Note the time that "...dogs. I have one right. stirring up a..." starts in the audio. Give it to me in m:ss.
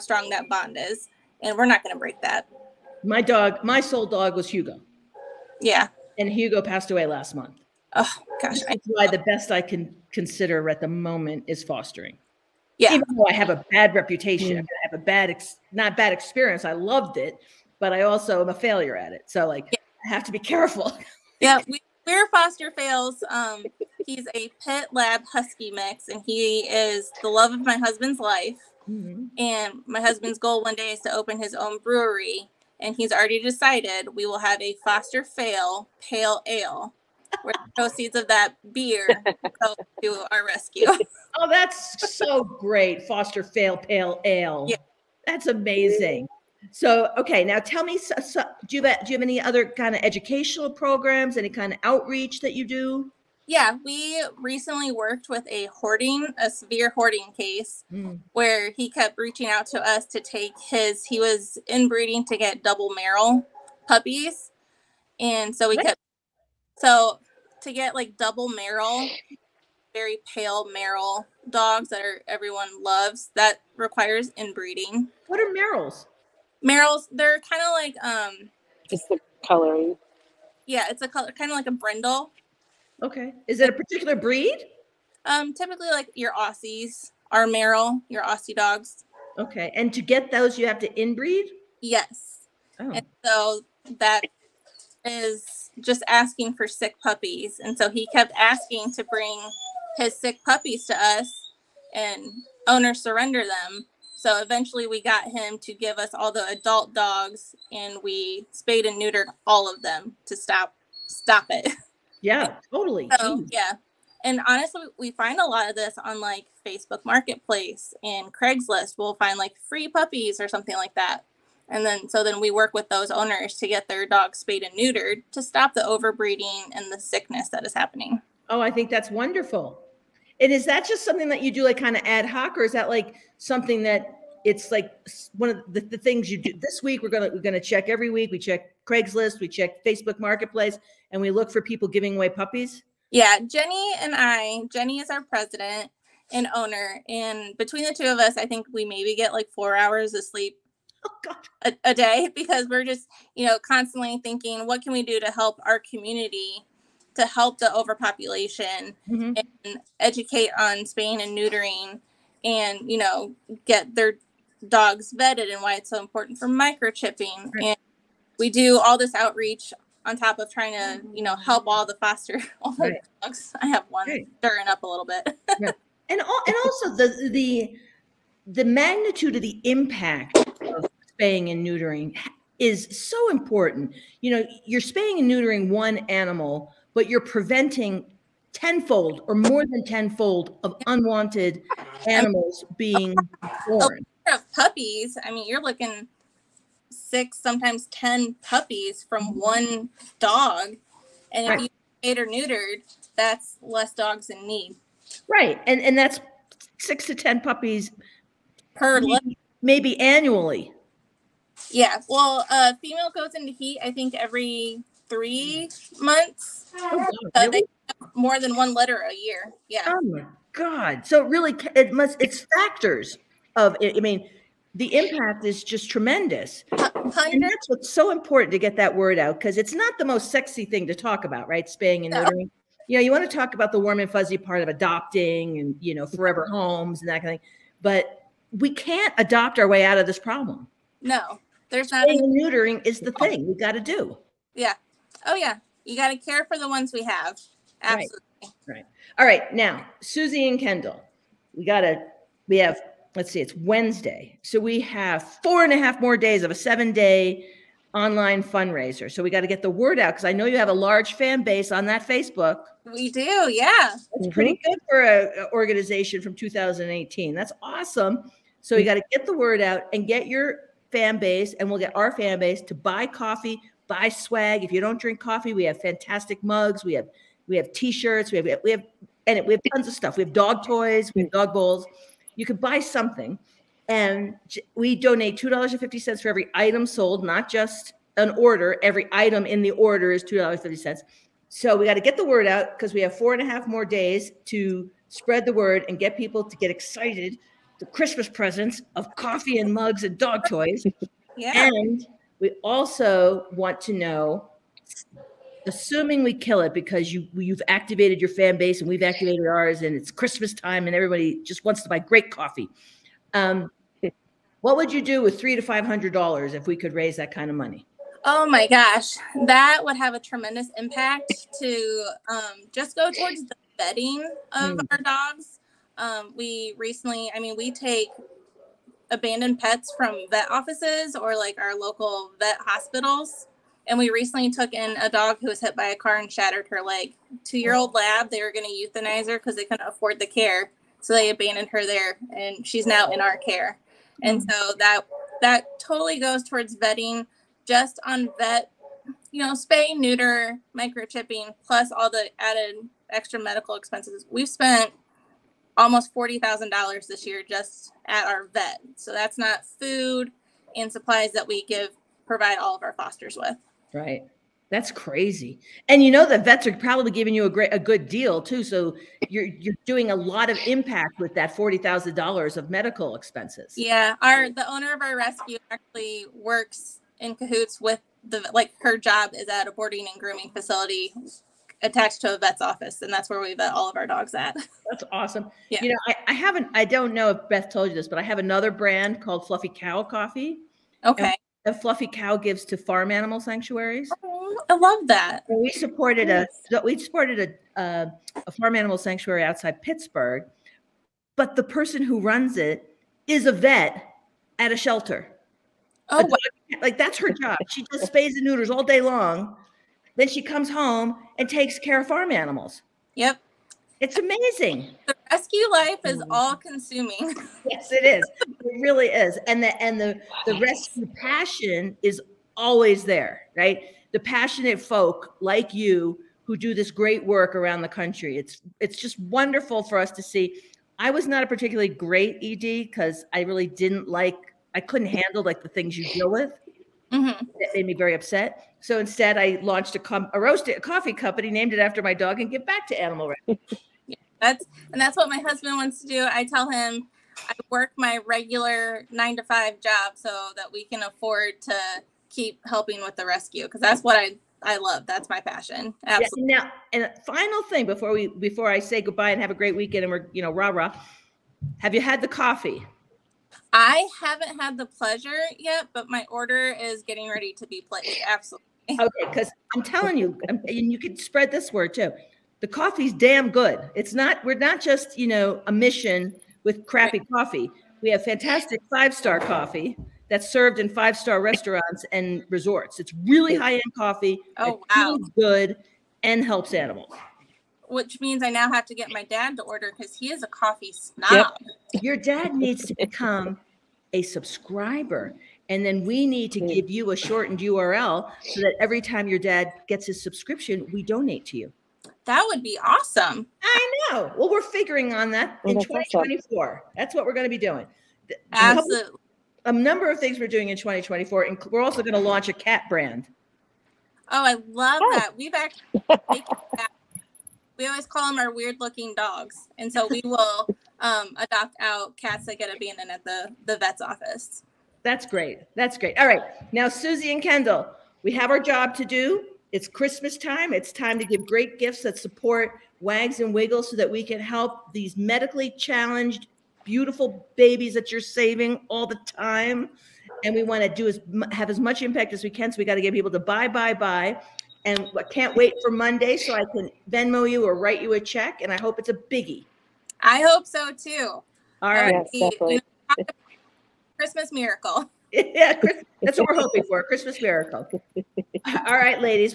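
2:53.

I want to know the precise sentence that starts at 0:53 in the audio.
Yeah, we recently worked with a hoarding, a severe hoarding case mm.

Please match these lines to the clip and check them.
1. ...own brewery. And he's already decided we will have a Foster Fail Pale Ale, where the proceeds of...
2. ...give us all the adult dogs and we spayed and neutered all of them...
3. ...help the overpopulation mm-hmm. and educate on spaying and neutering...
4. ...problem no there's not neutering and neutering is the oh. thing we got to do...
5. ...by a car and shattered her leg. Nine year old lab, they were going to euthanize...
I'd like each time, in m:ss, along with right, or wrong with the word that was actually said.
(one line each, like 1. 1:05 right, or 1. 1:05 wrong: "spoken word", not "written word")
1. 0:31 right
2. 1:45 right
3. 2:37 right
4. 4:00 wrong: "spaying", not "neutering"
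5. 5:35 wrong: "Two", not "Nine".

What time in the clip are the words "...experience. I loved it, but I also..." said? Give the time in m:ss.
0:16.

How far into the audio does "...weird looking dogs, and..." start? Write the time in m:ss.
8:38.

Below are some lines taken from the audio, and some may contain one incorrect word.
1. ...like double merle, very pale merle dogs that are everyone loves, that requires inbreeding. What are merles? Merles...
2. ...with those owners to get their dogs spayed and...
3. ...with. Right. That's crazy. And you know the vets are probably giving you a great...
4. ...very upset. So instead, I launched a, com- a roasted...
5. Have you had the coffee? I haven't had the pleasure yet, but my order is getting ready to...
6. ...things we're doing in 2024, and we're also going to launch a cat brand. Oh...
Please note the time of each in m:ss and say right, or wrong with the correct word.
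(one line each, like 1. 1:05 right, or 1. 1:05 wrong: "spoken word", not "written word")
1. 1:07 right
2. 2:02 right
3. 6:03 right
4. 7:17 right
5. 7:41 right
6. 8:30 right.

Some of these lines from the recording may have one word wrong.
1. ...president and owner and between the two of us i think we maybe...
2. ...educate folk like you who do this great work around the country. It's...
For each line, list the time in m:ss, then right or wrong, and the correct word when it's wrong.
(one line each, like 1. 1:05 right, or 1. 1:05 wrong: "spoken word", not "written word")
1. 2:25 right
2. 7:04 wrong: "passionate", not "educate".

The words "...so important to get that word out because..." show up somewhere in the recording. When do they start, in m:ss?
3:47.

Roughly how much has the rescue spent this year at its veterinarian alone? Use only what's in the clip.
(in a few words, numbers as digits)
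$40,000.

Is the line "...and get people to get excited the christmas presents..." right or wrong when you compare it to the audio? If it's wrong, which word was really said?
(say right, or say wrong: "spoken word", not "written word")
right.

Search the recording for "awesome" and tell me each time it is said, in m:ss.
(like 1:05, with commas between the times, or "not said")
4:27, 6:25, 8:22.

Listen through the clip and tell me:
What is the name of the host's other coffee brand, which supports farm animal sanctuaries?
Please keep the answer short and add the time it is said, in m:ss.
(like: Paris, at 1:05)
Fluffy Cow Coffee, at 6:29.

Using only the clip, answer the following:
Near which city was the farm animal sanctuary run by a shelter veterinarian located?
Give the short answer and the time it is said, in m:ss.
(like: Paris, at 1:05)
Pittsburgh, at 6:39.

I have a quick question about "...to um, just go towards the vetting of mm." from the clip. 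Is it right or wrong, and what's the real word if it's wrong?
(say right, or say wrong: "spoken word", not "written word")
right.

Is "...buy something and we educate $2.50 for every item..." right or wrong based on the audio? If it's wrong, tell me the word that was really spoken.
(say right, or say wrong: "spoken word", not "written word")
wrong: "donate", not "educate".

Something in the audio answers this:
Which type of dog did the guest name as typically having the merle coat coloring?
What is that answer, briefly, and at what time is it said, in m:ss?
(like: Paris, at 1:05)
Aussies, at 1:26.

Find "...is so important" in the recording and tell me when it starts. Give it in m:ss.
3:02.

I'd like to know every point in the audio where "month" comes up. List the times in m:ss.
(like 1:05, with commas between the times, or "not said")
0:07, 3:35.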